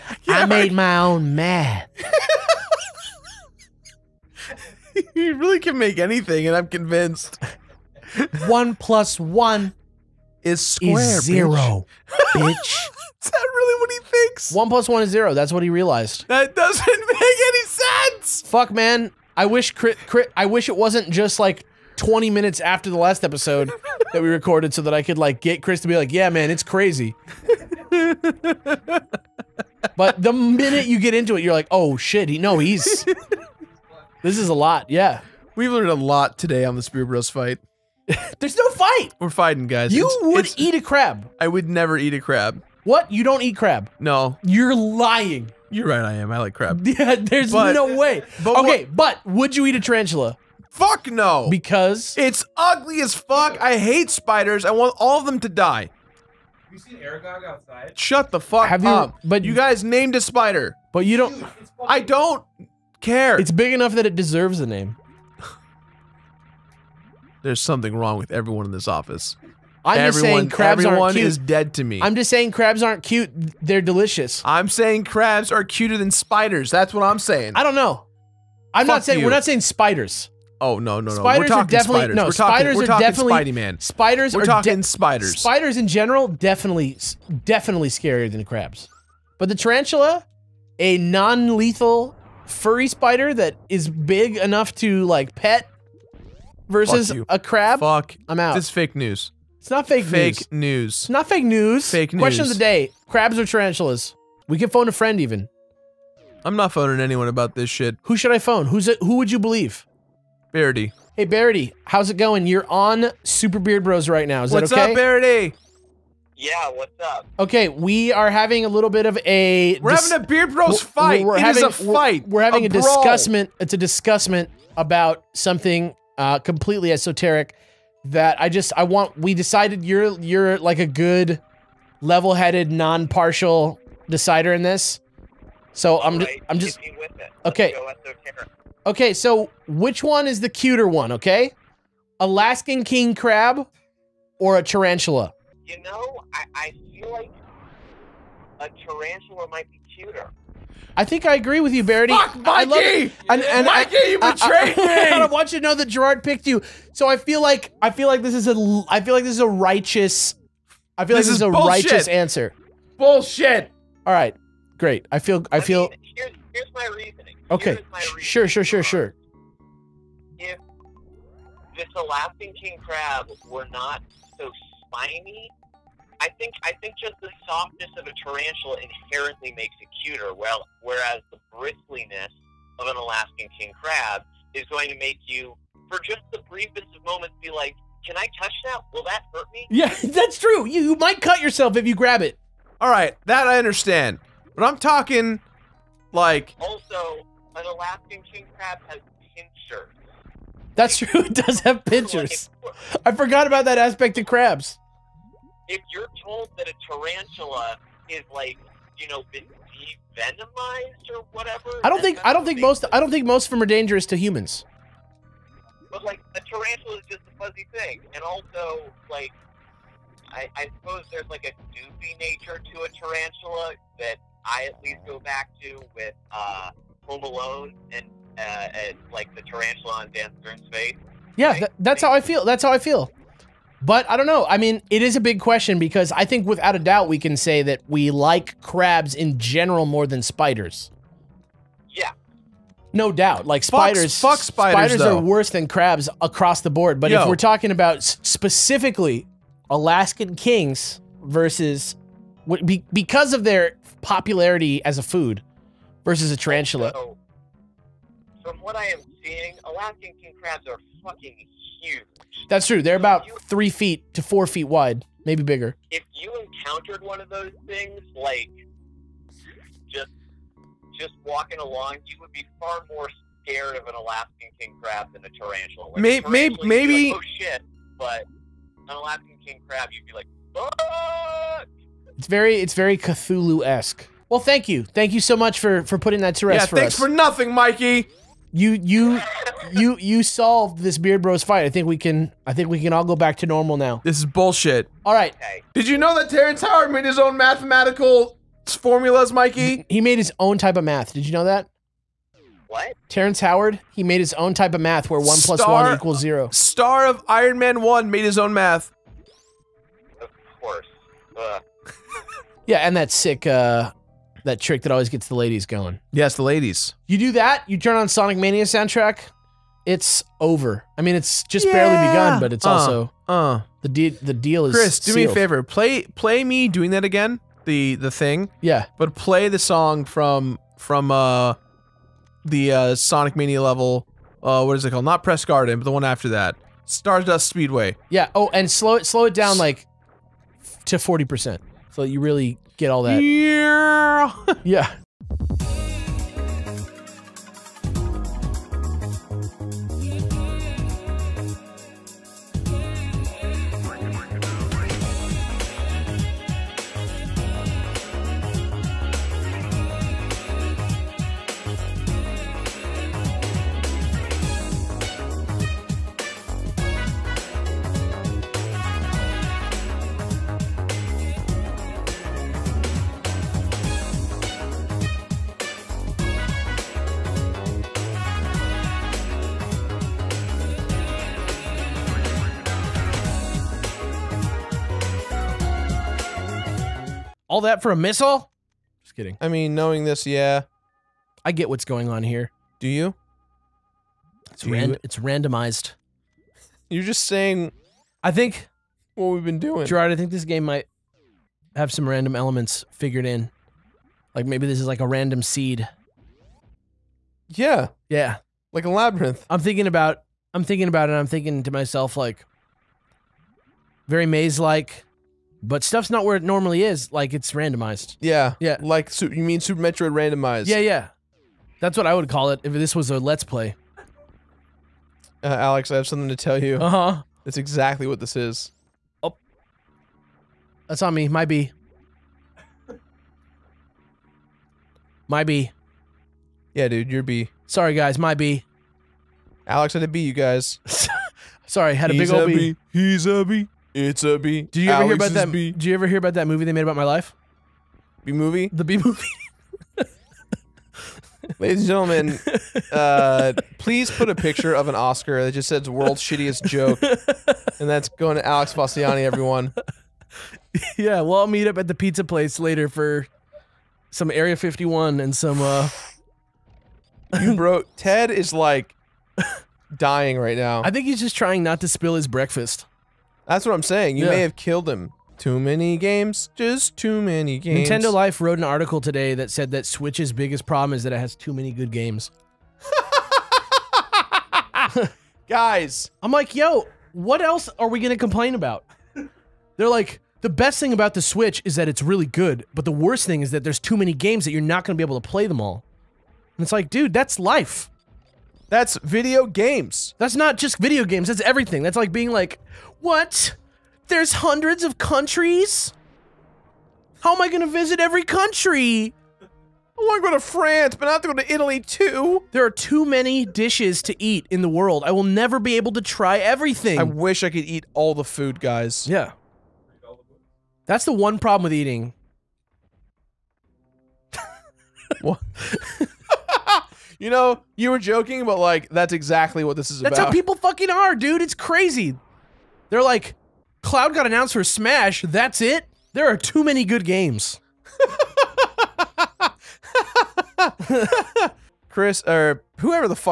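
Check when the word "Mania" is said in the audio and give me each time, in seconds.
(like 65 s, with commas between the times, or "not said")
318 s, 333 s.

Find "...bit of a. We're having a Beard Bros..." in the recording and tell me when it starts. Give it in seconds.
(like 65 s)
118 s.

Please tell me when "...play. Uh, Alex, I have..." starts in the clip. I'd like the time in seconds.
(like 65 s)
423 s.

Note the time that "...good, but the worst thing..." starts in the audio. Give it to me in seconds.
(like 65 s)
492 s.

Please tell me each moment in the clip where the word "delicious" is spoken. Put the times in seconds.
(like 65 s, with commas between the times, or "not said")
73 s.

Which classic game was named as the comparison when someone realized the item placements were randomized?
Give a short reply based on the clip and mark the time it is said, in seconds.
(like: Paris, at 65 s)
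Super Metroid, at 419 s.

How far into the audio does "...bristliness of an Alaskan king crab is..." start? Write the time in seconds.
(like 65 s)
181 s.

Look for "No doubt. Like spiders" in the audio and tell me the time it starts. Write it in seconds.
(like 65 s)
242 s.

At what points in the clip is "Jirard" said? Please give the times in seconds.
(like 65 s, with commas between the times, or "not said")
155 s, 399 s.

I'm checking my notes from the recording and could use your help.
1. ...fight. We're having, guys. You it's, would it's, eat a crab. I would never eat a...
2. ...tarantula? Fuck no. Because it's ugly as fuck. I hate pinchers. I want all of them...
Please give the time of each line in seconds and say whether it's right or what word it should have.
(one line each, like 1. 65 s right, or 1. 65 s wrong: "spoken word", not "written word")
1. 38 s wrong: "fighting", not "having"
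2. 49 s wrong: "spiders", not "pinchers".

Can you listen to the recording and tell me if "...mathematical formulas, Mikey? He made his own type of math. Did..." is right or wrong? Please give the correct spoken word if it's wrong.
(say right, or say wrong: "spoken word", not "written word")
right.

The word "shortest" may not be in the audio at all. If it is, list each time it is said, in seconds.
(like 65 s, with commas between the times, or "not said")
not said.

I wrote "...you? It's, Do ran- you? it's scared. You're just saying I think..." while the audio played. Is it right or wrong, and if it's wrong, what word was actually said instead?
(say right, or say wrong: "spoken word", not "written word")
wrong: "randomized", not "scared".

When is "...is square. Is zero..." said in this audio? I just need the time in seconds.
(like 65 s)
10 s.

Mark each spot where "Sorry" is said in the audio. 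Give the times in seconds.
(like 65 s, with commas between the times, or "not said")
437 s, 441 s.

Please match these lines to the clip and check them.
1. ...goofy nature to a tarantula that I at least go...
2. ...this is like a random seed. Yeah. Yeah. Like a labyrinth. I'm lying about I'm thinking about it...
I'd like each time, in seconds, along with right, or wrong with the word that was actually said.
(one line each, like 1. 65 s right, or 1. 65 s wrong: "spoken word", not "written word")
1. 221 s right
2. 404 s wrong: "thinking", not "lying".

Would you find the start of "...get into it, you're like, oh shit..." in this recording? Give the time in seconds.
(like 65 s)
30 s.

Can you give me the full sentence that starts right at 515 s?
I will never be able to try everything.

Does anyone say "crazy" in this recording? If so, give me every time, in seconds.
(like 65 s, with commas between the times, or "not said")
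26 s, 531 s.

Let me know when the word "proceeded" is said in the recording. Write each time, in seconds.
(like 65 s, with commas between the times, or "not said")
not said.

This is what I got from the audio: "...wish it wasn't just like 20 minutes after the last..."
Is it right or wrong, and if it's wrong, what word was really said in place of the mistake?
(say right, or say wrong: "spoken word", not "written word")
right.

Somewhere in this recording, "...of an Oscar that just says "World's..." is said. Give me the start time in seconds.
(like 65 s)
454 s.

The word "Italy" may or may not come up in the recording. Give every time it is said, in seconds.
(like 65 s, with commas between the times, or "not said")
511 s.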